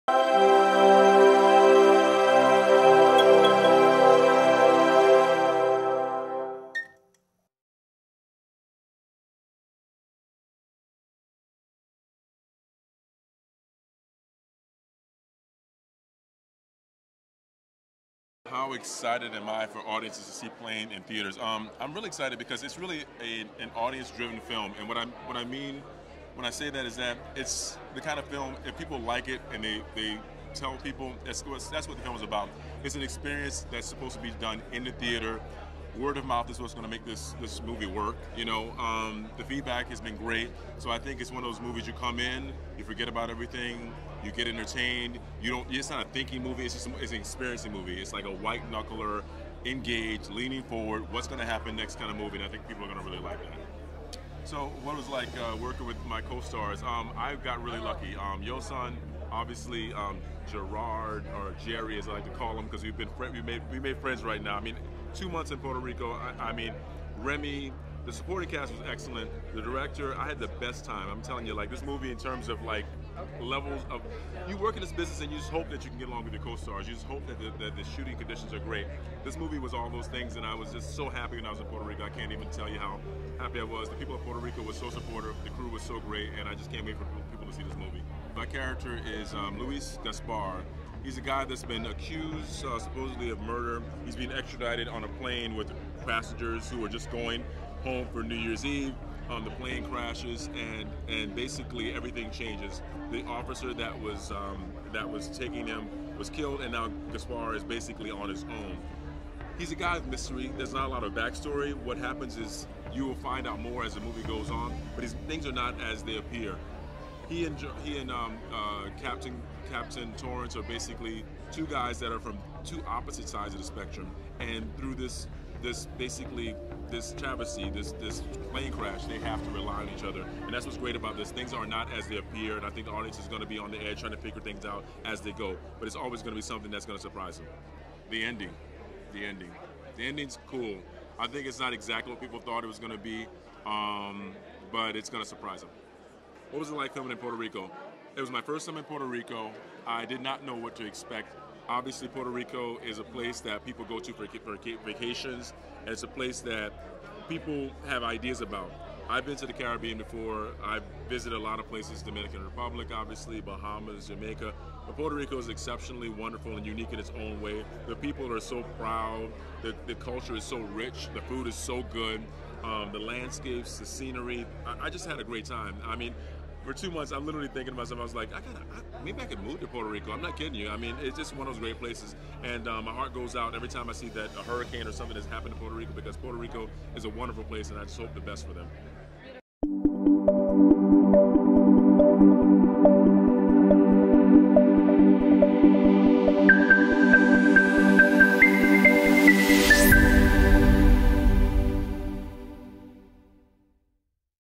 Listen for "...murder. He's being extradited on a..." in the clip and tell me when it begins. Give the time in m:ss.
1:33.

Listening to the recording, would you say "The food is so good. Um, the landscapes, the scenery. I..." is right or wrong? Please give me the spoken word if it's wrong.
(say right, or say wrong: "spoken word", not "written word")
right.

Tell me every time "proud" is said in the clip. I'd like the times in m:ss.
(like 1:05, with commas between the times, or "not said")
2:48.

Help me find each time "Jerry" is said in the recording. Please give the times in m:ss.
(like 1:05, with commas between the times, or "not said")
1:01.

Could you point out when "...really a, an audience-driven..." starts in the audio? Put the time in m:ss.
0:22.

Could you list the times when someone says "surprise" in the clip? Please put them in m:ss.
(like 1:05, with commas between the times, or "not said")
2:17, 2:25.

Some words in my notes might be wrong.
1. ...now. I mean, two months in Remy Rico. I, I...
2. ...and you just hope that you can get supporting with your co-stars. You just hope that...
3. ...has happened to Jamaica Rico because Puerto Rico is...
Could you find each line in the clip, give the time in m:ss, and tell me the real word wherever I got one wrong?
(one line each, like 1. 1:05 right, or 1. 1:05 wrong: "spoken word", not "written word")
1. 1:04 wrong: "Puerto", not "Remy"
2. 1:15 wrong: "along", not "supporting"
3. 3:05 wrong: "Puerto", not "Jamaica".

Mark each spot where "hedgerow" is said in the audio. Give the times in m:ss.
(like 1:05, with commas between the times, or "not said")
not said.